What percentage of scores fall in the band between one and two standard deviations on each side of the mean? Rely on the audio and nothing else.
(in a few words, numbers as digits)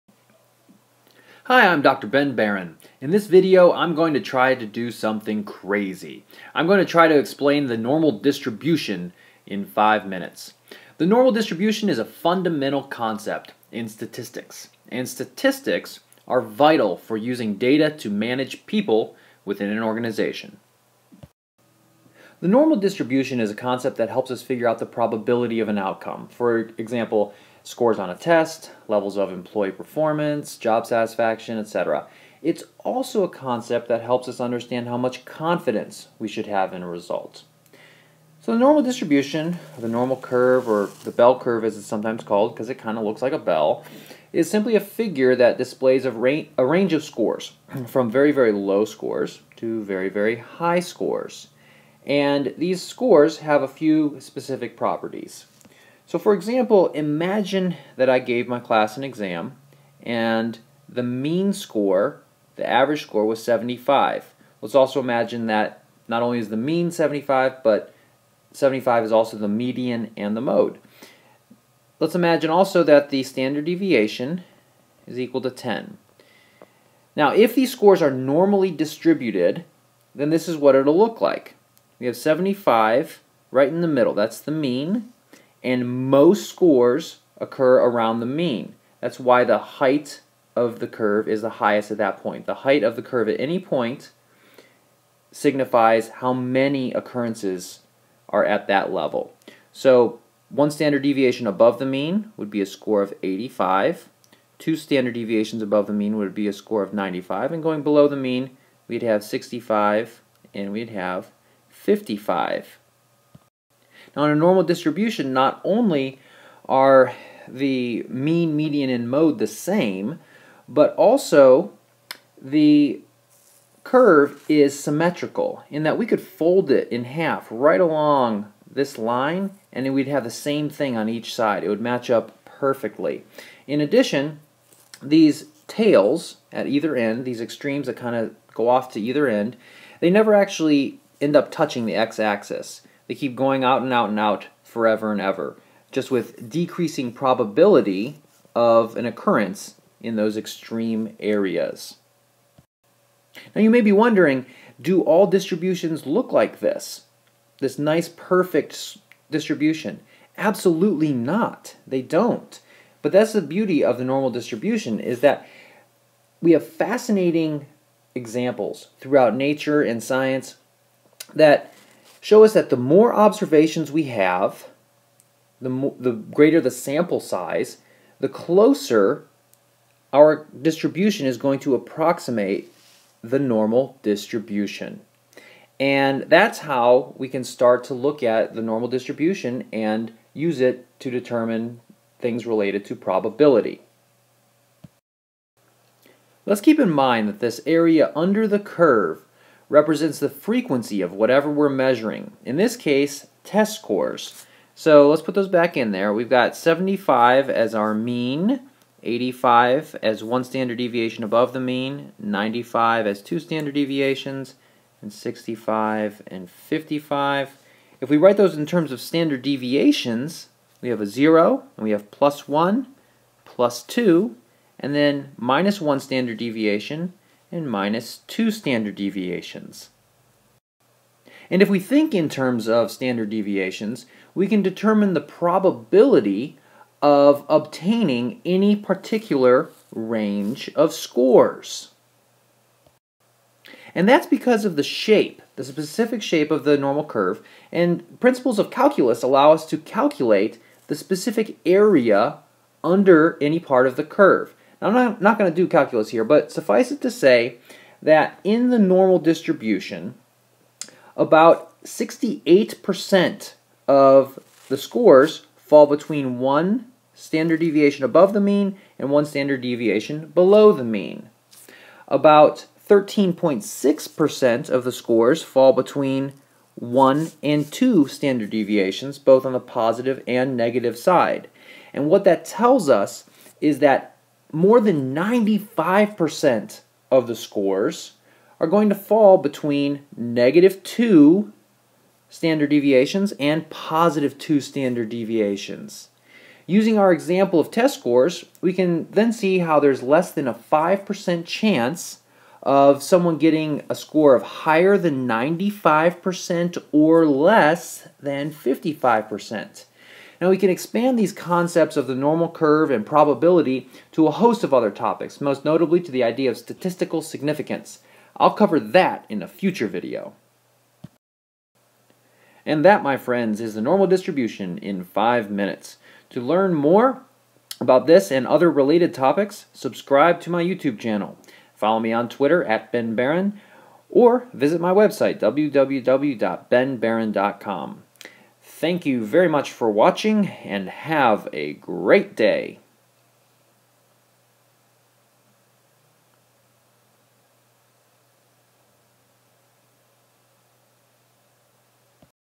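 13.6%.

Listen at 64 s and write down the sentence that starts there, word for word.
Let's also imagine that not only is the mean 75, but 75 is also the median and the mode.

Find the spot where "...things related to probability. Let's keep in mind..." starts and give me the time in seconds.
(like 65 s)
192 s.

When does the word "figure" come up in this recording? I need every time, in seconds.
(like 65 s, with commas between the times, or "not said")
24 s, 44 s.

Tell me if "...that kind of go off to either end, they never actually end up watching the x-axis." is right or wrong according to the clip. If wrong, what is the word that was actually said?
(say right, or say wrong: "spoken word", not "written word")
wrong: "touching", not "watching".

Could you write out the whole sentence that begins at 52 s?
And these scores have a few specific properties.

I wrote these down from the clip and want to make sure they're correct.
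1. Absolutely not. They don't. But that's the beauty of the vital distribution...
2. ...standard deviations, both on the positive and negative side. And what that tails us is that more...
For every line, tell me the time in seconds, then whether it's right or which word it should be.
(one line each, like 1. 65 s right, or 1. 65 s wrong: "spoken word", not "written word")
1. 160 s wrong: "normal", not "vital"
2. 278 s wrong: "tells", not "tails".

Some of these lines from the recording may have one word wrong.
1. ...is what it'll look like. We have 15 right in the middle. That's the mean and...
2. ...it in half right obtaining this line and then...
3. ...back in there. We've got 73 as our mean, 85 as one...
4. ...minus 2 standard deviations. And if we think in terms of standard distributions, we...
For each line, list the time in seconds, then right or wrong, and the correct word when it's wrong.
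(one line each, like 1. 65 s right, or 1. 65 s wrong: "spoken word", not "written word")
1. 80 s wrong: "75", not "15"
2. 126 s wrong: "along", not "obtaining"
3. 205 s wrong: "75", not "73"
4. 227 s wrong: "deviations", not "distributions".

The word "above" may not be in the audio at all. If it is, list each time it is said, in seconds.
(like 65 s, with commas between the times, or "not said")
101 s, 105 s, 211 s, 268 s.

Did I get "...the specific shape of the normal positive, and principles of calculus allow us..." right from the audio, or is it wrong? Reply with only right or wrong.
wrong.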